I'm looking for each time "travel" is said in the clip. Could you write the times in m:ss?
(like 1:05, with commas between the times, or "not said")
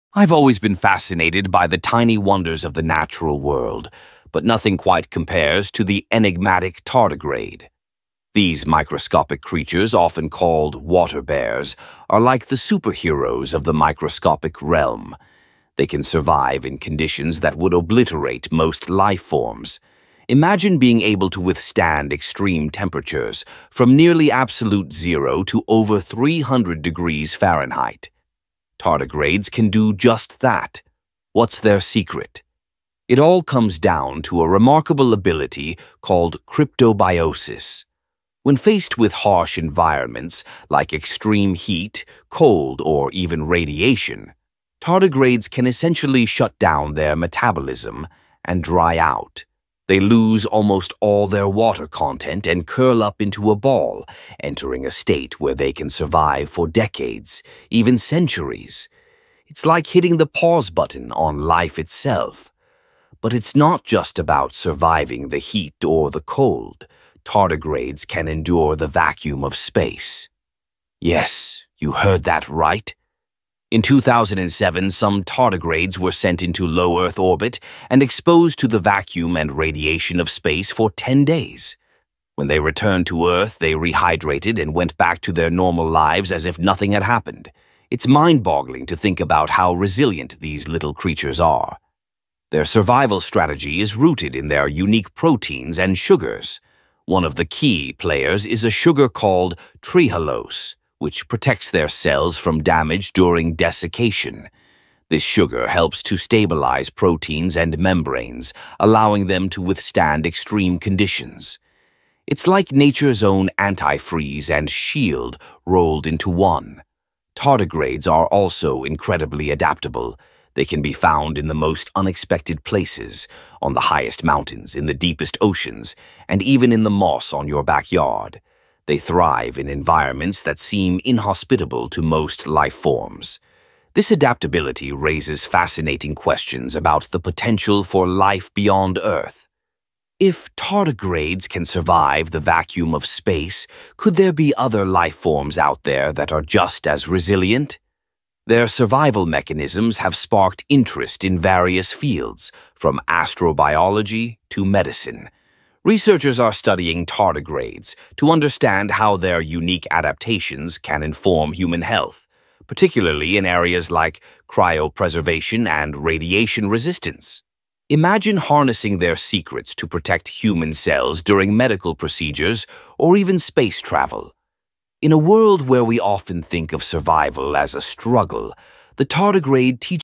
2:53.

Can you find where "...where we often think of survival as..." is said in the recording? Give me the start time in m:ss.
2:55.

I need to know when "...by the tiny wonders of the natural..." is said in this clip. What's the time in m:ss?
0:01.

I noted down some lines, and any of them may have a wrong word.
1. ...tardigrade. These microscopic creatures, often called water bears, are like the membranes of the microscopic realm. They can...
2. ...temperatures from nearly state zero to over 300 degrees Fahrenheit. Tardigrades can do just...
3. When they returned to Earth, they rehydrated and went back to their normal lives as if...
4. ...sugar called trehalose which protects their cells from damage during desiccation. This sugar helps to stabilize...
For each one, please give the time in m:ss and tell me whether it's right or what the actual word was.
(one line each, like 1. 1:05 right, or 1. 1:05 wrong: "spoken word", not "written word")
1. 0:06 wrong: "superheroes", not "membranes"
2. 0:22 wrong: "absolute", not "state"
3. 1:22 right
4. 1:38 right.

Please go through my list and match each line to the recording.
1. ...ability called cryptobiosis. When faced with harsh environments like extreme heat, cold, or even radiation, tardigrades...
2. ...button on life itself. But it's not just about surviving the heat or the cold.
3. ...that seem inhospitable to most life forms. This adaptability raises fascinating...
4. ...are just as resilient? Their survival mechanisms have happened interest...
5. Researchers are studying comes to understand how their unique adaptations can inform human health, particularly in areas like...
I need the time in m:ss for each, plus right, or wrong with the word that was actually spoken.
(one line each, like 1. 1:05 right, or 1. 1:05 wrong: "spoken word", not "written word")
1. 0:35 right
2. 1:00 right
3. 2:10 right
4. 2:26 wrong: "sparked", not "happened"
5. 2:35 wrong: "tardigrades", not "comes".